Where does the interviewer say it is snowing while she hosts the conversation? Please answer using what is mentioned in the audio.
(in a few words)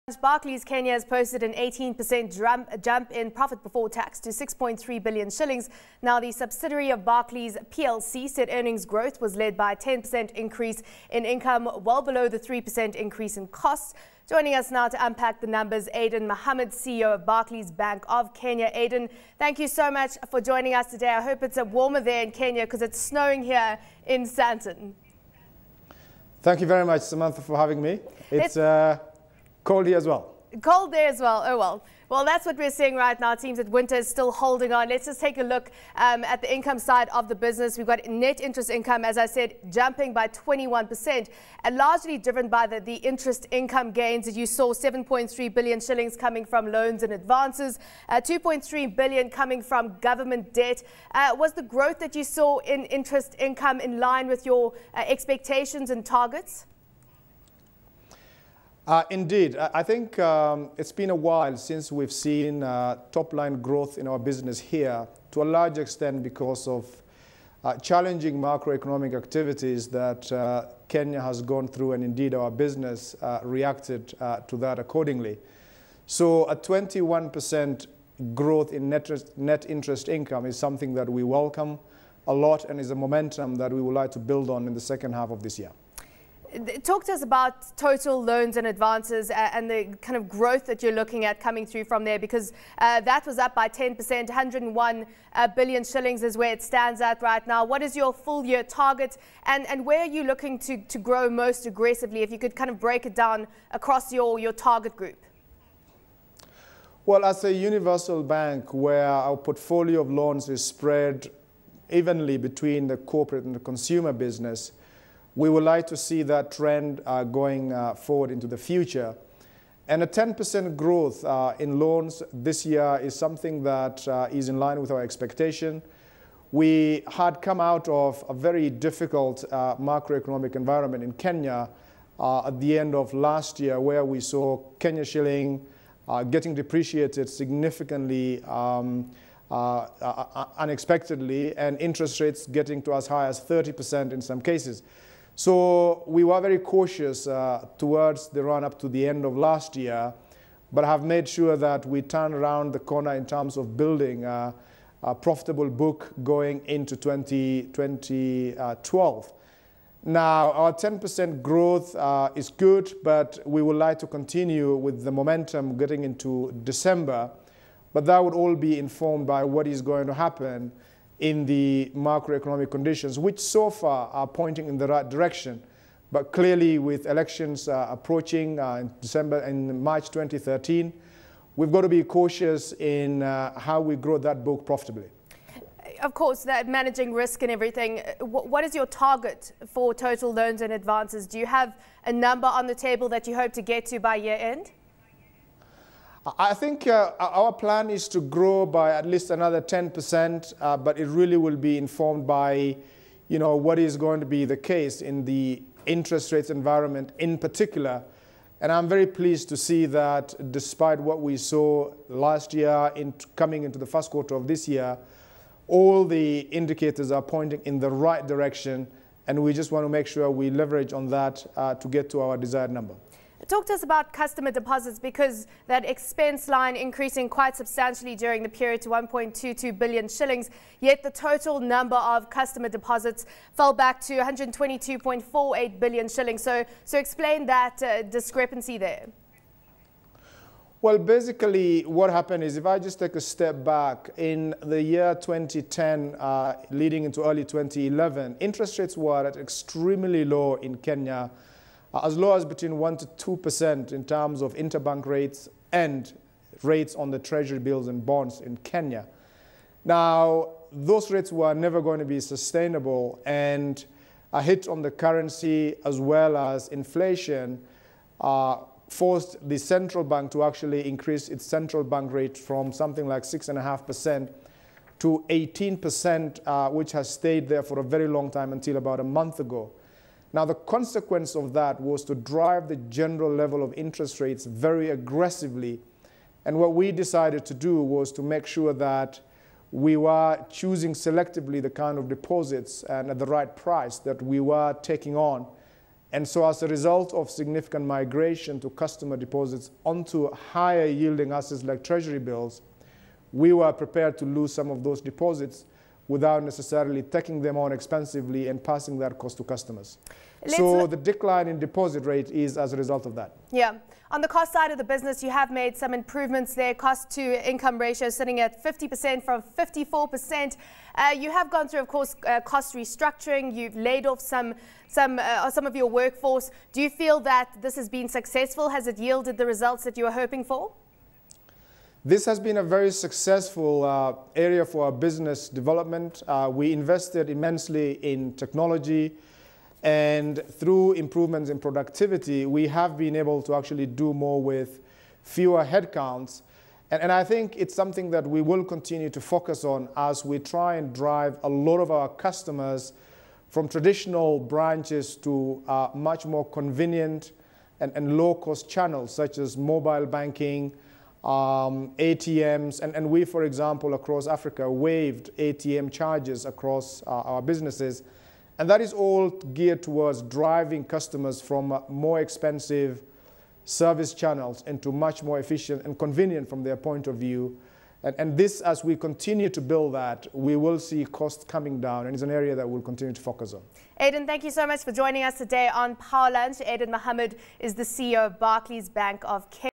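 Sandton.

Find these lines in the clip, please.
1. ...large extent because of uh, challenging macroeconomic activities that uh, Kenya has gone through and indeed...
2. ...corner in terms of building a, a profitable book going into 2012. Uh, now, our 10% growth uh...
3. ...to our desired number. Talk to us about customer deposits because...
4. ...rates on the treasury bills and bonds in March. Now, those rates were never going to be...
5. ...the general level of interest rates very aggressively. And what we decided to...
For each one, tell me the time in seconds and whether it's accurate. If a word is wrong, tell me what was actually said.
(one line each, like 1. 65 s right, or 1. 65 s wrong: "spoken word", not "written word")
1. 65 s right
2. 152 s right
3. 222 s right
4. 256 s wrong: "Kenya", not "March"
5. 282 s right.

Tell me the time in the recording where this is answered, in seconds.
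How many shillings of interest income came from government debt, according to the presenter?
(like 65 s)
48 s.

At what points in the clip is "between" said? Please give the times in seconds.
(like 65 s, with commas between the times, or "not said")
112 s, 252 s.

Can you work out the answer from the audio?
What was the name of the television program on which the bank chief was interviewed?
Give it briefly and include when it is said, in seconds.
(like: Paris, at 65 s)
Power Lunch, at 385 s.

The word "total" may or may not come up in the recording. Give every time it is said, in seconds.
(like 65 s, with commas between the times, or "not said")
87 s, 189 s, 231 s.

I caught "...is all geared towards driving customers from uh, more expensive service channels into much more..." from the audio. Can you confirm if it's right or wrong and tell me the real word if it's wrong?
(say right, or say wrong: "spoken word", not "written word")
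right.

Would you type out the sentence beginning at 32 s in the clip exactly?
Well, that's what we're seeing right now.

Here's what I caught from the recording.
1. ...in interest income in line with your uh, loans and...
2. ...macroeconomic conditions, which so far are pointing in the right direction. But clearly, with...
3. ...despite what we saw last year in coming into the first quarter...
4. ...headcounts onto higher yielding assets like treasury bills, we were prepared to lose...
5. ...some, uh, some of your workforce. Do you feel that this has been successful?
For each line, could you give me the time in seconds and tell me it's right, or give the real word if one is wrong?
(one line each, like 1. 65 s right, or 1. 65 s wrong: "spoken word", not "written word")
1. 52 s wrong: "expectations", not "loans"
2. 171 s right
3. 210 s right
4. 299 s wrong: "deposits", not "headcounts"
5. 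324 s right.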